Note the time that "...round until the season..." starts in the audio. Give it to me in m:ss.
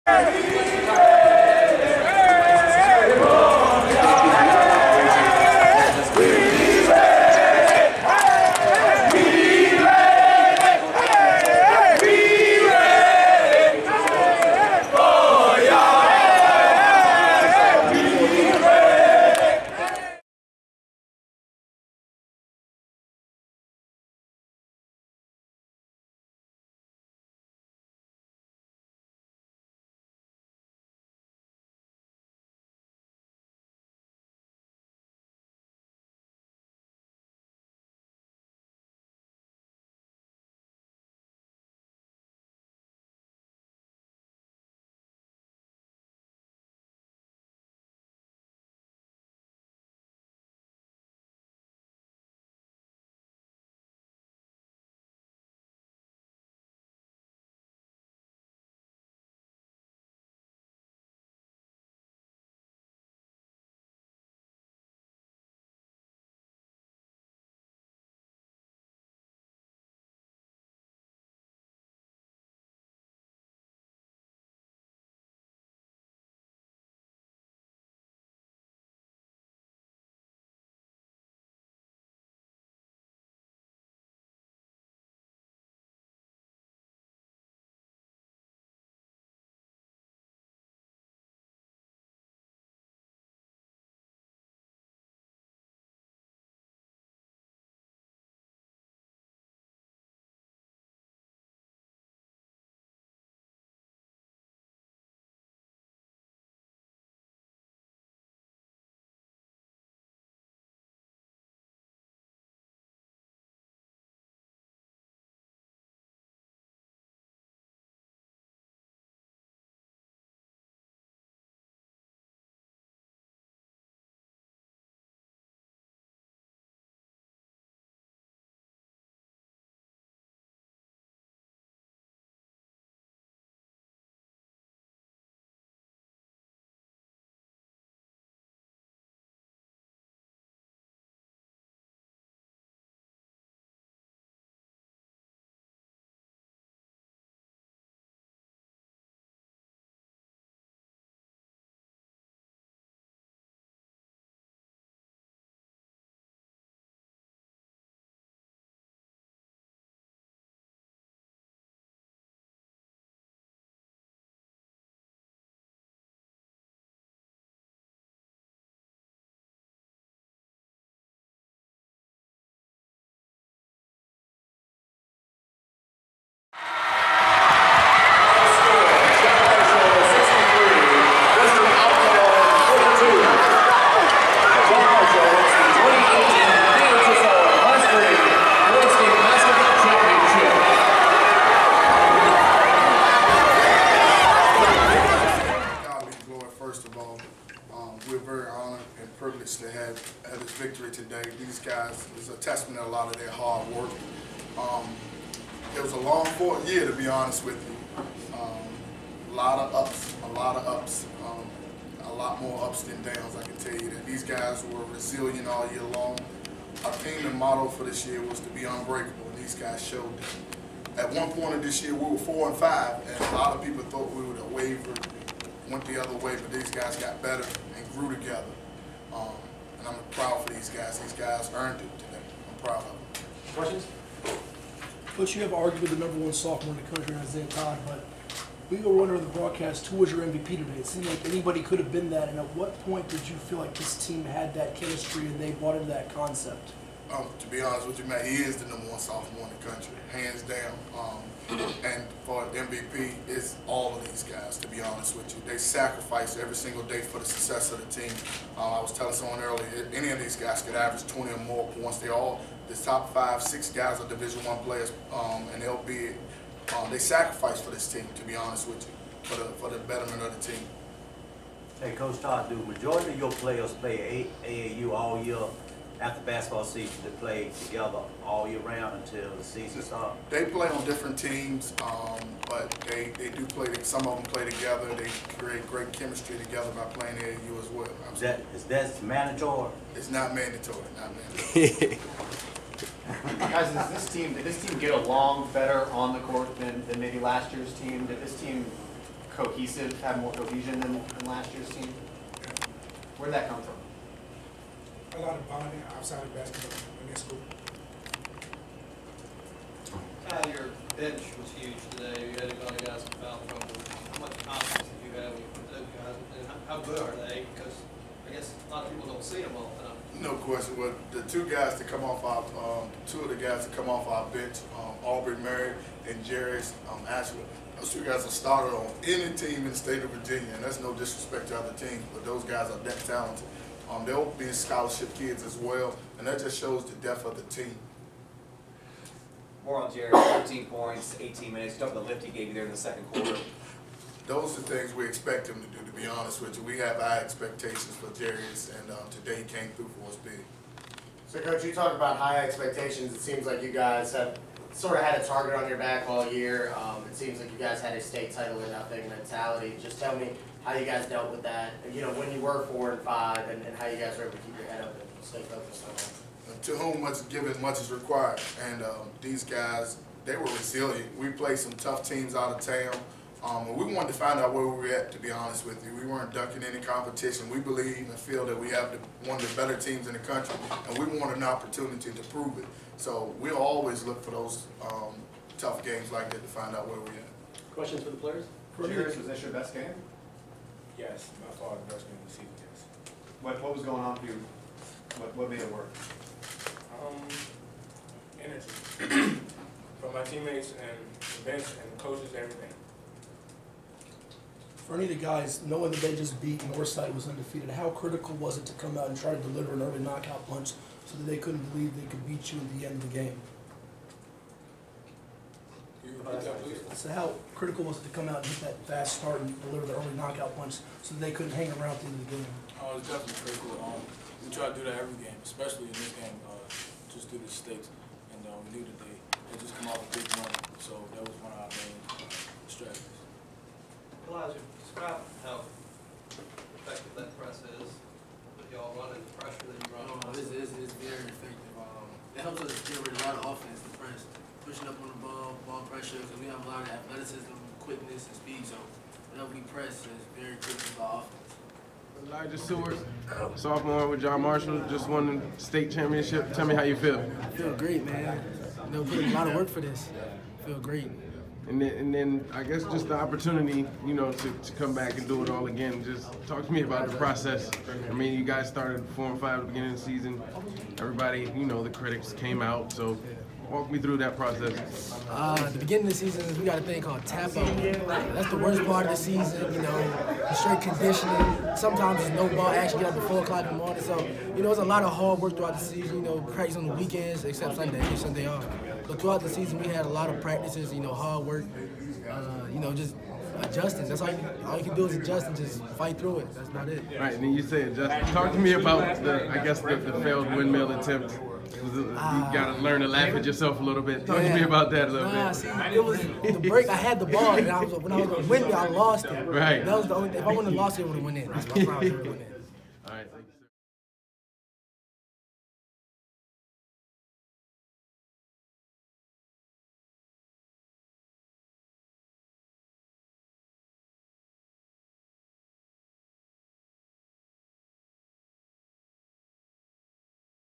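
4:38.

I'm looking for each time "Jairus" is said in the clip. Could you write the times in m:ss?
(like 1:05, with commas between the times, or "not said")
5:26, 5:48.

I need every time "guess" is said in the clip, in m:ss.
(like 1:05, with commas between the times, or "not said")
5:18, 7:42, 8:19.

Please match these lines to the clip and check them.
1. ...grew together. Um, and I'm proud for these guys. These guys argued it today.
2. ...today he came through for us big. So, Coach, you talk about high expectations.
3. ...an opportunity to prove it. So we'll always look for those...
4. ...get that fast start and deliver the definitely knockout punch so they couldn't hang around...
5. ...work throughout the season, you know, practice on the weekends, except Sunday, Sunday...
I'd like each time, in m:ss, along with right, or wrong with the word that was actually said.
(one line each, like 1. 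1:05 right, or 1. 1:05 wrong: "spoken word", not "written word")
1. 3:47 wrong: "earned", not "argued"
2. 5:49 right
3. 6:21 right
4. 6:58 wrong: "early", not "definitely"
5. 8:05 right.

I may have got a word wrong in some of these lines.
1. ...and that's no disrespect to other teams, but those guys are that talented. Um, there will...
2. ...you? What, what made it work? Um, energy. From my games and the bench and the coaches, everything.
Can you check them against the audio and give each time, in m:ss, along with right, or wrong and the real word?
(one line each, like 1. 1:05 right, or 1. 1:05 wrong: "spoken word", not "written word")
1. 5:30 right
2. 6:34 wrong: "teammates", not "games".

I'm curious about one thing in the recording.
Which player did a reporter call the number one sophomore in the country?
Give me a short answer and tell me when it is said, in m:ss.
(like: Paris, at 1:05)
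Isaiah Todd, at 3:57.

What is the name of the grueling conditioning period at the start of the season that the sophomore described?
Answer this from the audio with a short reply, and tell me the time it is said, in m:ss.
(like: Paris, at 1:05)
Tap up, at 7:57.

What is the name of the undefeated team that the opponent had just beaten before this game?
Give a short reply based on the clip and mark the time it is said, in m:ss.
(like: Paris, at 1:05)
Northside, at 6:46.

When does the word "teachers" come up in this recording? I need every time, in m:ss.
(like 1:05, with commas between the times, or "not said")
not said.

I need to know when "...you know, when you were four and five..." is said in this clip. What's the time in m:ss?
6:01.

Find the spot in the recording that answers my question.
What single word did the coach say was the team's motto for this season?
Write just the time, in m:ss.
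3:38.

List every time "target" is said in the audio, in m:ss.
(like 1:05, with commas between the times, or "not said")
5:55.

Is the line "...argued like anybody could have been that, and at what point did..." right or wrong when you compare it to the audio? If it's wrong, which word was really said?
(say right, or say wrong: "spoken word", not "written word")
wrong: "seemed", not "argued".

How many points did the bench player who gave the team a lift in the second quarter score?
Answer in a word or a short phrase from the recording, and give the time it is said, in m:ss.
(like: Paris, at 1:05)
14, at 5:40.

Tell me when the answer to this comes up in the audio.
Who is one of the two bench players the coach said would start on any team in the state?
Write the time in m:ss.
5:25.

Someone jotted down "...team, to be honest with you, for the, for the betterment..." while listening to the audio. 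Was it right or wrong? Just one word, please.
right.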